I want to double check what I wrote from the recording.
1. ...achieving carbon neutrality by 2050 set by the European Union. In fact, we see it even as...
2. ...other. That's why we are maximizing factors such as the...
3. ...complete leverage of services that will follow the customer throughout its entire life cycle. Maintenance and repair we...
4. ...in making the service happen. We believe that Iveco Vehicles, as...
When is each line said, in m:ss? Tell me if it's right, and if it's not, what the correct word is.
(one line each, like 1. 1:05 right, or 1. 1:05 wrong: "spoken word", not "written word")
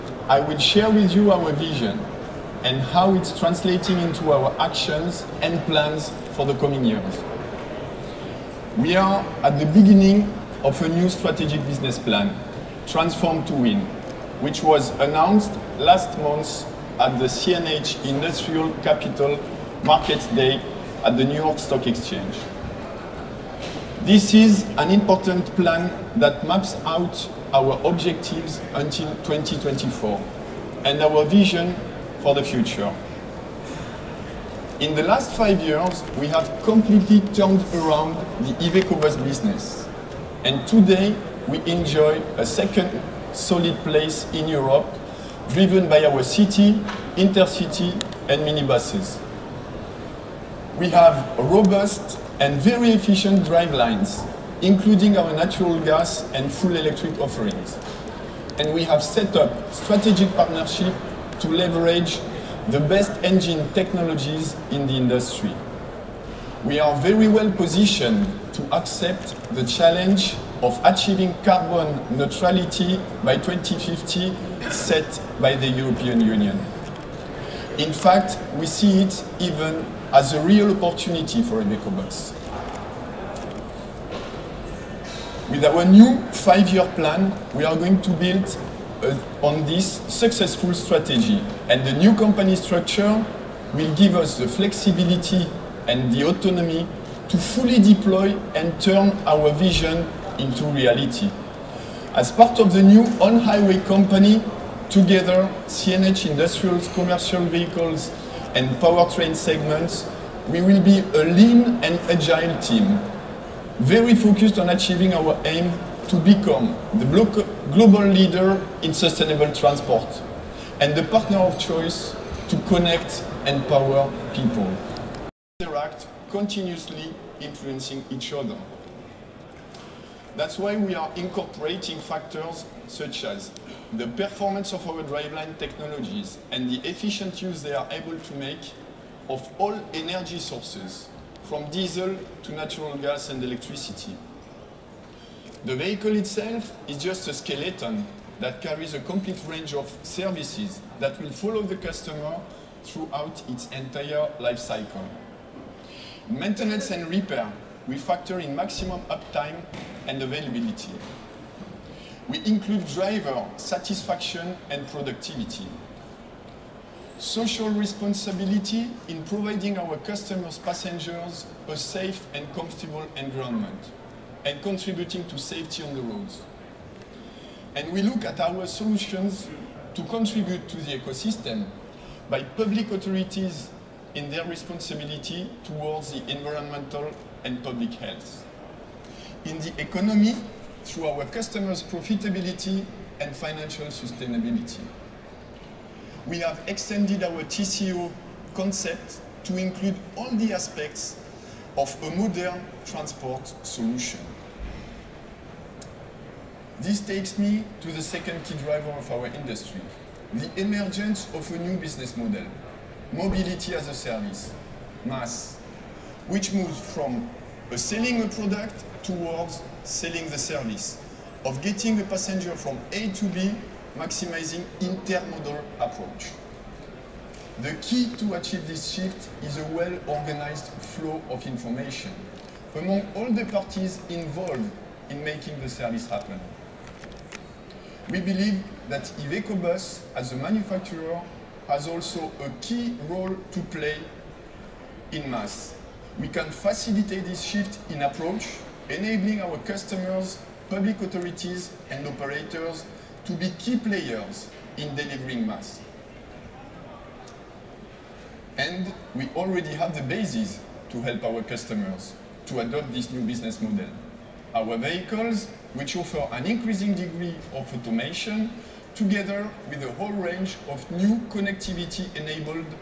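1. 1:10 right
2. 2:08 wrong: "incorporating", not "maximizing"
3. 2:28 wrong: "range", not "leverage"
4. 3:55 wrong: "Bus", not "Vehicles".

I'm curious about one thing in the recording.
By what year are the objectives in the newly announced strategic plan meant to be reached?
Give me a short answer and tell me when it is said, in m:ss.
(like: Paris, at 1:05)
2024, at 0:29.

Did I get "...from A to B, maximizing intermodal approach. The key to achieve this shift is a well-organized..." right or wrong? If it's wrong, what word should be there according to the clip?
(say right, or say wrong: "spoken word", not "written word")
right.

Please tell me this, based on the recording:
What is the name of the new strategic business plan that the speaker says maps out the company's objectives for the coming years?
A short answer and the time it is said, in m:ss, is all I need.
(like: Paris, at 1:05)
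Transform to Win, at 0:12.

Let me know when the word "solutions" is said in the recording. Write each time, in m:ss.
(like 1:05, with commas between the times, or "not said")
2:58, 3:23.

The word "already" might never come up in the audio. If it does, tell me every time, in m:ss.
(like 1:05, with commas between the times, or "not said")
4:19.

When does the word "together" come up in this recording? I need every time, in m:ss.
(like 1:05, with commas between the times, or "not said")
1:44, 4:28.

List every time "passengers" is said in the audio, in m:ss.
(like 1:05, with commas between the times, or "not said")
2:50, 3:42.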